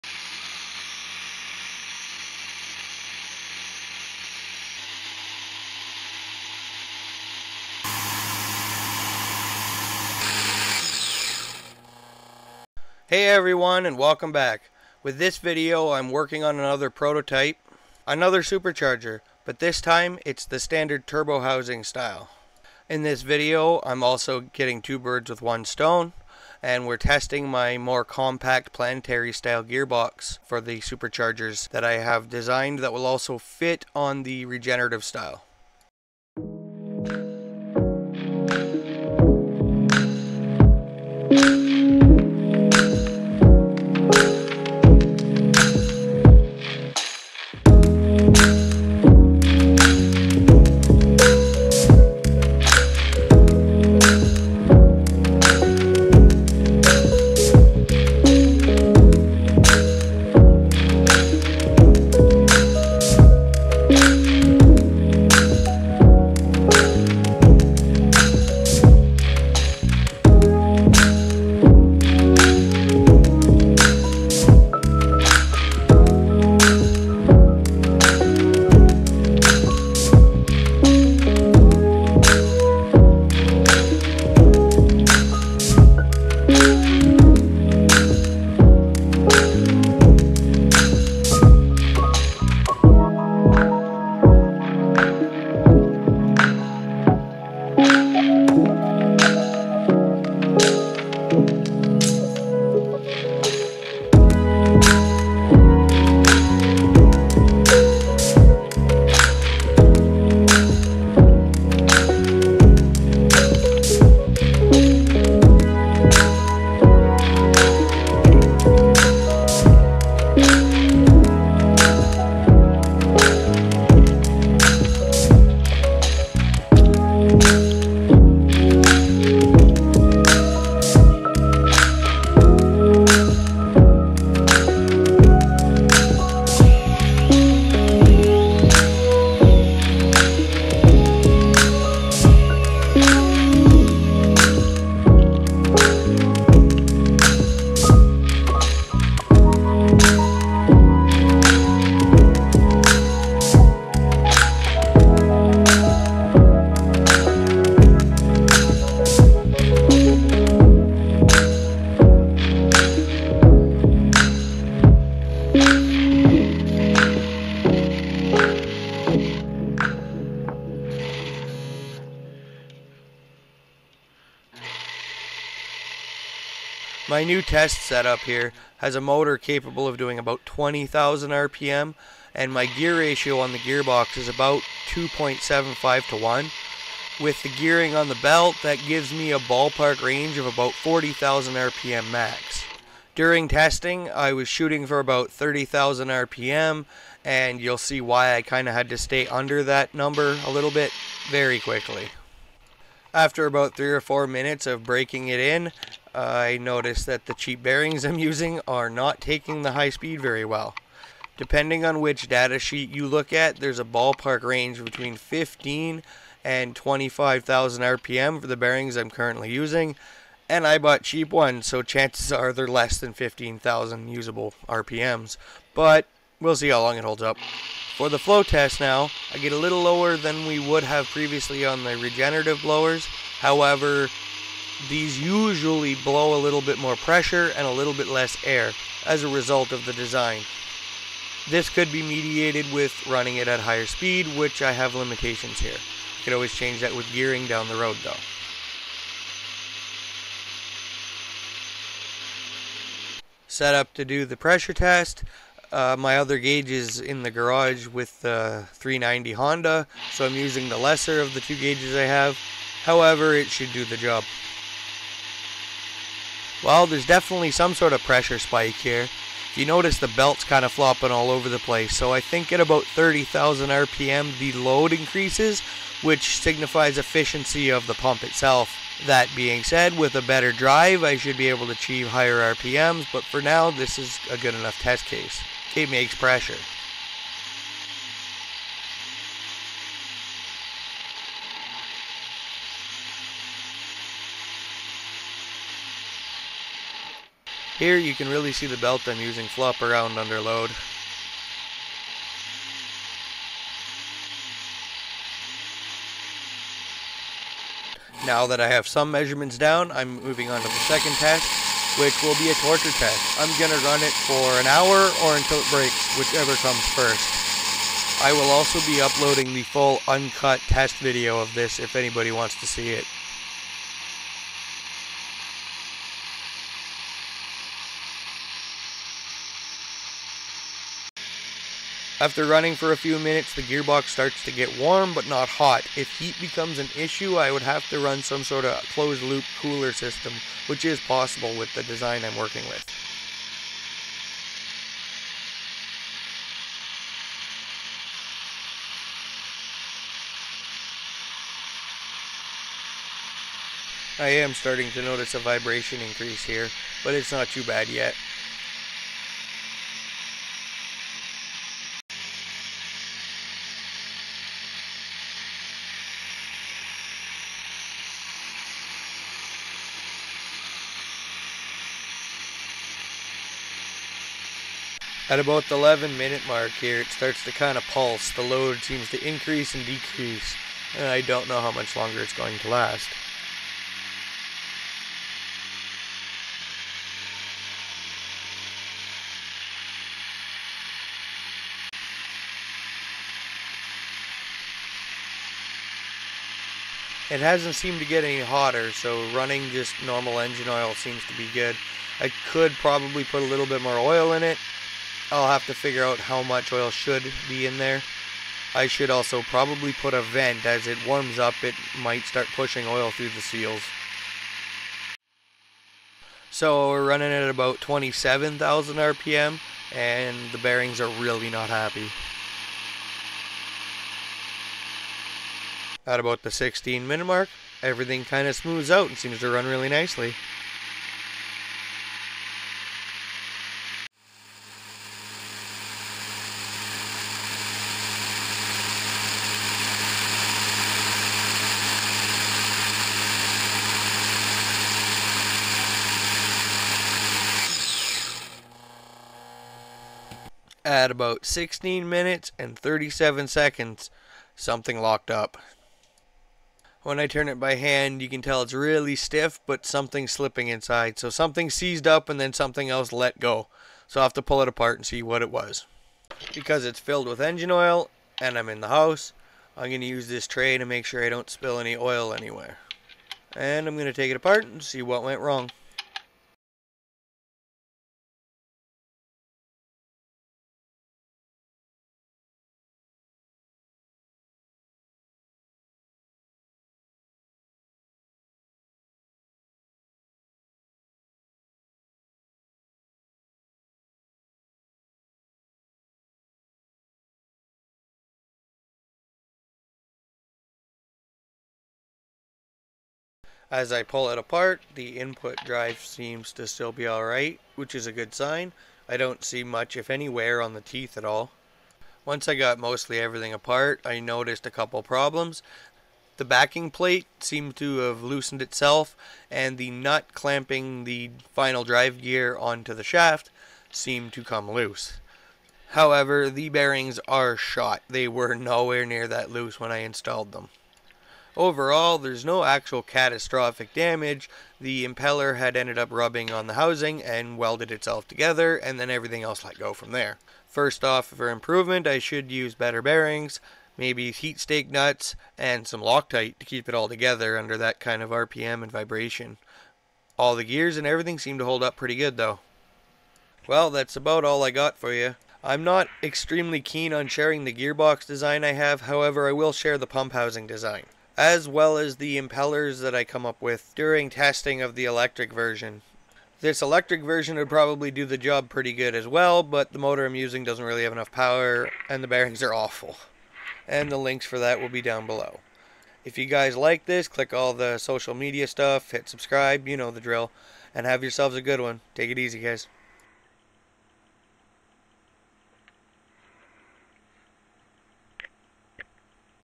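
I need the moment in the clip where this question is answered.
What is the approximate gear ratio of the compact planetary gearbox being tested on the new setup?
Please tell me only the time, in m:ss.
3:04.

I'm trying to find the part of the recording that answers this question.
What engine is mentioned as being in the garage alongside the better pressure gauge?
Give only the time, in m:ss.
4:18.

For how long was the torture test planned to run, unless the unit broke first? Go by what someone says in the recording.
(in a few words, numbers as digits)
an hour.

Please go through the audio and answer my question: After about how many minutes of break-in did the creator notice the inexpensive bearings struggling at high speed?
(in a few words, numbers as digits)
three or four minutes.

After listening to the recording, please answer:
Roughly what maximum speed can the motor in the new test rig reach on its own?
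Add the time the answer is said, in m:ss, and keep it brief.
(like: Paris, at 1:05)
20,000 RPM, at 3:00.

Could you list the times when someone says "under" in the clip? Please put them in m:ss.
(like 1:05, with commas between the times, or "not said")
3:19, 5:00, 9:07.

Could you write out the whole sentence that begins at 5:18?
I will also be uploading the full uncut test video of this if anybody wants to see it.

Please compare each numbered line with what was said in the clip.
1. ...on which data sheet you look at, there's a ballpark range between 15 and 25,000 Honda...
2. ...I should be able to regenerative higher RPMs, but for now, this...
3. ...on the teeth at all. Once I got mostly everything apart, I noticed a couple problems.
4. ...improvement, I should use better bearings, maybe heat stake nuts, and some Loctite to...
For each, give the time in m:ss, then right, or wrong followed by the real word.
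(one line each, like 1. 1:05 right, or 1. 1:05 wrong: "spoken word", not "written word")
1. 3:31 wrong: "RPM", not "Honda"
2. 4:41 wrong: "achieve", not "regenerative"
3. 8:30 right
4. 9:01 right.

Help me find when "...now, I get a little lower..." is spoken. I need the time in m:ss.
3:48.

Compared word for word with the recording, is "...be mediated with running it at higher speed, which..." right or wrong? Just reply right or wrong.
right.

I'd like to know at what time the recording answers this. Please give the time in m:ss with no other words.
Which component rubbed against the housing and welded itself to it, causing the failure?
8:54.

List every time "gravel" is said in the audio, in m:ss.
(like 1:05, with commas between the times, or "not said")
not said.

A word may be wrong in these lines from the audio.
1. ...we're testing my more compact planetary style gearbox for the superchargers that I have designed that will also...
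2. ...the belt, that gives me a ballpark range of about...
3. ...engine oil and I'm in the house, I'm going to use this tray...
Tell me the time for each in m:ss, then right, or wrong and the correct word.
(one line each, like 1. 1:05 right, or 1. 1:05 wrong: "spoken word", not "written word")
1. 0:26 right
2. 3:08 right
3. 7:47 right.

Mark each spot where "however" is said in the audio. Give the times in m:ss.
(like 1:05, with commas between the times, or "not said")
3:53, 4:22, 8:45, 9:19.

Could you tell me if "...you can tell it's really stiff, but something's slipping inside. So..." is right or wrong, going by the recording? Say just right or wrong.
right.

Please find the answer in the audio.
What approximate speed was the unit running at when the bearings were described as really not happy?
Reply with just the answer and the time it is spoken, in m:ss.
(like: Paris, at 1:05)
27,000 RPM, at 6:57.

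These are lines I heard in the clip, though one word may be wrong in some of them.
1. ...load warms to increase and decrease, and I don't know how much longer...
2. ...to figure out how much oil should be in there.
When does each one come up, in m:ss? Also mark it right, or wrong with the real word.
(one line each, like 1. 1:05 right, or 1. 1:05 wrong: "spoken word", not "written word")
1. 6:18 wrong: "seems", not "warms"
2. 6:45 right.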